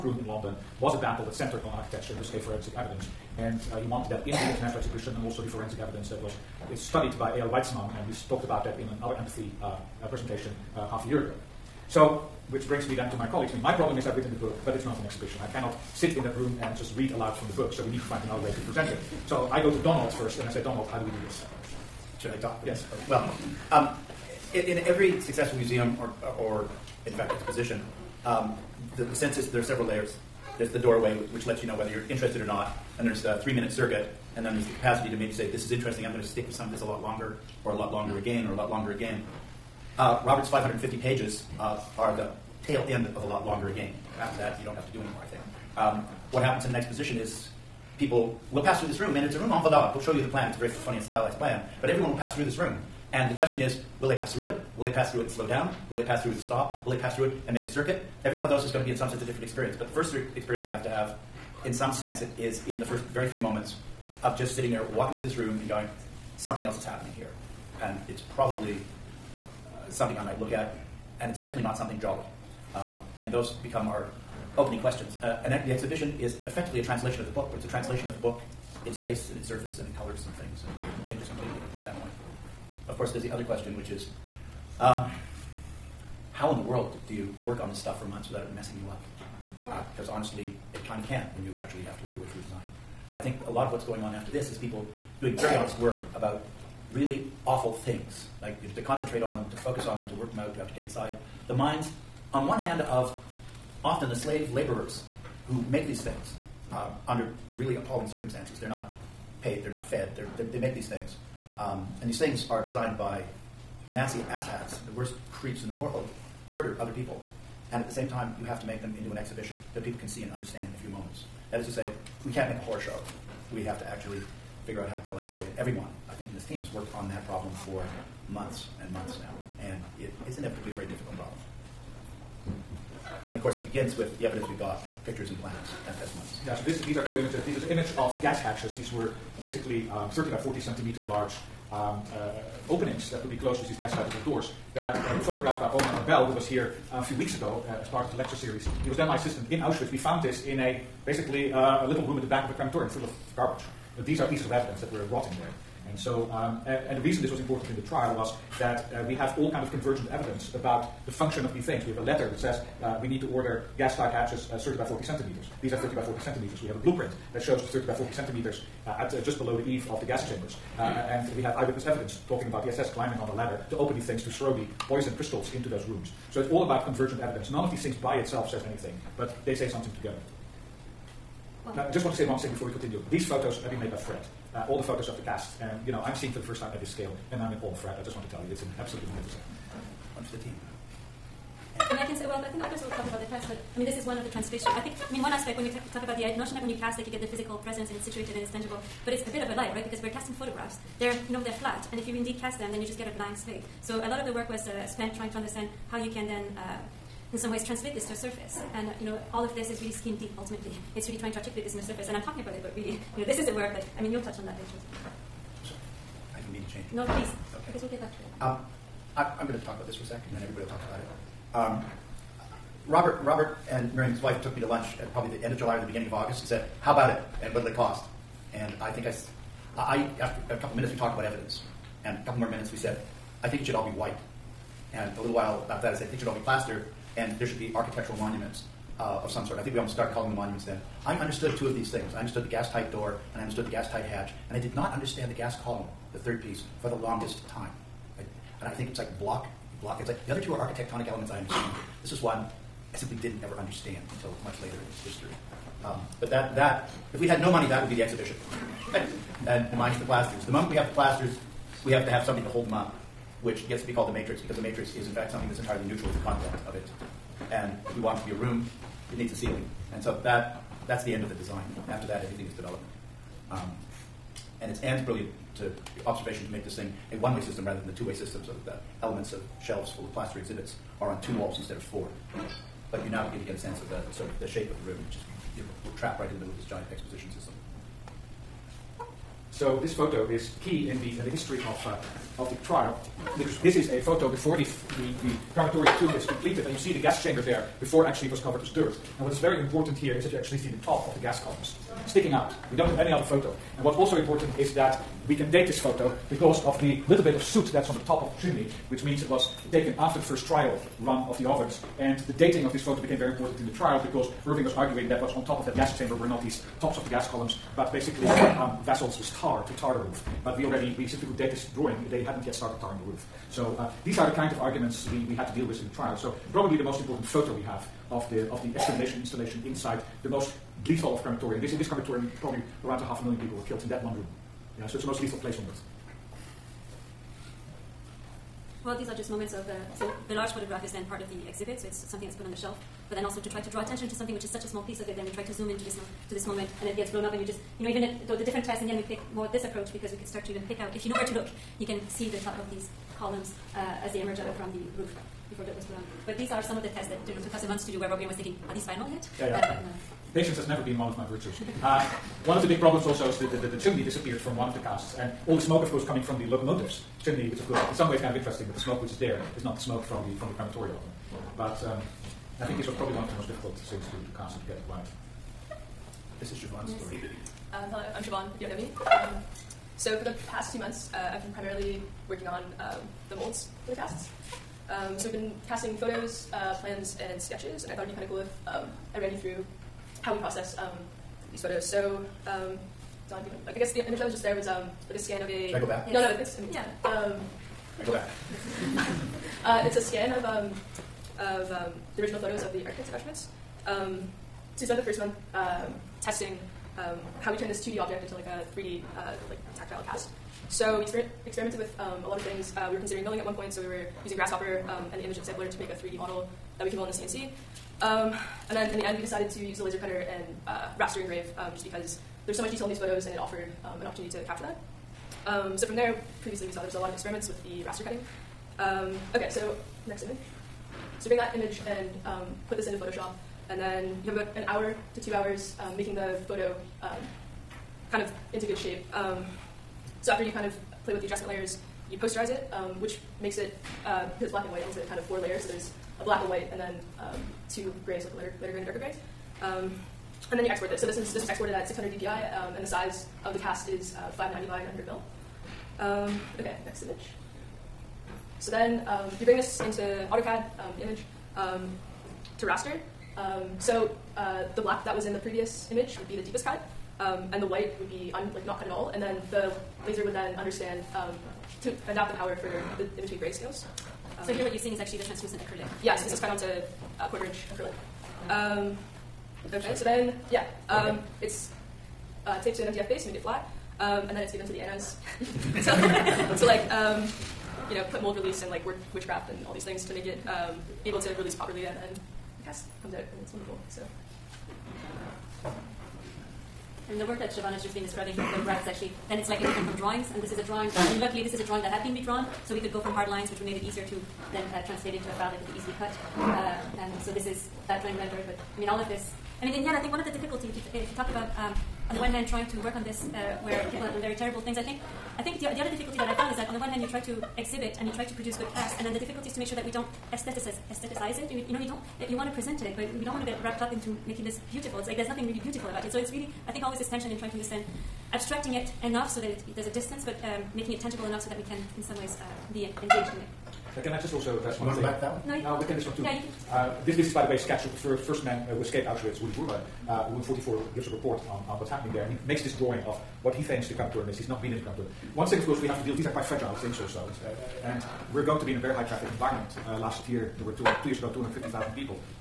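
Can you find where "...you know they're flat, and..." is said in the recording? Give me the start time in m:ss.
3:21.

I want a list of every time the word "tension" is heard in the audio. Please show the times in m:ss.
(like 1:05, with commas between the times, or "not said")
8:47.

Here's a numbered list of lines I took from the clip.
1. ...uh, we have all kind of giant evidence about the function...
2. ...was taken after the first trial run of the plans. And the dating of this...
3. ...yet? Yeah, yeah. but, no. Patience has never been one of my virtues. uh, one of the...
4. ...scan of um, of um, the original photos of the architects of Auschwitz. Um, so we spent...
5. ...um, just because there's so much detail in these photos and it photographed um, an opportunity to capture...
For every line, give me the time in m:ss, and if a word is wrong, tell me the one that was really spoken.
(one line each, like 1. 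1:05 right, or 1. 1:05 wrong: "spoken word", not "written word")
1. 2:38 wrong: "convergent", not "giant"
2. 5:09 wrong: "ovens", not "plans"
3. 5:59 right
4. 6:40 right
5. 7:01 wrong: "offered", not "photographed".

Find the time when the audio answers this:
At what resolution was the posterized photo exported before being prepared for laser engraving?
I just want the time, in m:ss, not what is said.
7:31.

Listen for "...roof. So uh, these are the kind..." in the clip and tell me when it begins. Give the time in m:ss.
5:23.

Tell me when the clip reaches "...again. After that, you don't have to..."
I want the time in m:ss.
0:43.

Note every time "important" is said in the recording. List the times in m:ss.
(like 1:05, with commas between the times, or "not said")
2:37, 4:59, 5:04, 5:13, 5:26.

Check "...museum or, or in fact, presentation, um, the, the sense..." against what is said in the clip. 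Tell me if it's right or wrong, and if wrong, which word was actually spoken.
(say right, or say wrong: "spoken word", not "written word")
wrong: "exposition", not "presentation".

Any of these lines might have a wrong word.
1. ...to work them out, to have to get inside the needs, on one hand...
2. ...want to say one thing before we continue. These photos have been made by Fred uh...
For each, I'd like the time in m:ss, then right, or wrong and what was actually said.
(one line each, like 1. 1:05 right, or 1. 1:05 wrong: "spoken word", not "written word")
1. 1:40 wrong: "minds", not "needs"
2. 3:02 right.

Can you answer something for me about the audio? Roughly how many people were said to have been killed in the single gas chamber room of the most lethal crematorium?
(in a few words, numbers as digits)
half a million.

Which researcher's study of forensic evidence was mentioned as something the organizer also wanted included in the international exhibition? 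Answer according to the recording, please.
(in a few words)
Eyal Weizman.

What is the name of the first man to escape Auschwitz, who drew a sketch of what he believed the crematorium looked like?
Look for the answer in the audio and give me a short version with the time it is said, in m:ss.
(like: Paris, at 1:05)
Rudi Vrba, at 8:59.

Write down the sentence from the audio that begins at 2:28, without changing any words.
He was then my assistant in Auschwitz.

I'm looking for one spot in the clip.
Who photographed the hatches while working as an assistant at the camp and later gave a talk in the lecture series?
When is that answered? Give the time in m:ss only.
2:25.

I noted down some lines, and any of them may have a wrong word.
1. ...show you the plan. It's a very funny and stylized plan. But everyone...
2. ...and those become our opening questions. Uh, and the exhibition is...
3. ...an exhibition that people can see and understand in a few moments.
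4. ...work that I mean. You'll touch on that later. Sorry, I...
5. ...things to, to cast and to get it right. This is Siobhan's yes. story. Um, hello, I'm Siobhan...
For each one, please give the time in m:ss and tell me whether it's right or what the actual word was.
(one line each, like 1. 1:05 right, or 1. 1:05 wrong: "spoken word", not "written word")
1. 0:50 right
2. 1:13 right
3. 1:59 right
4. 3:33 right
5. 6:13 right.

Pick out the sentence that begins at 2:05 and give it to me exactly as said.
And everyone, I think, in this team has worked on that problem for months and months now.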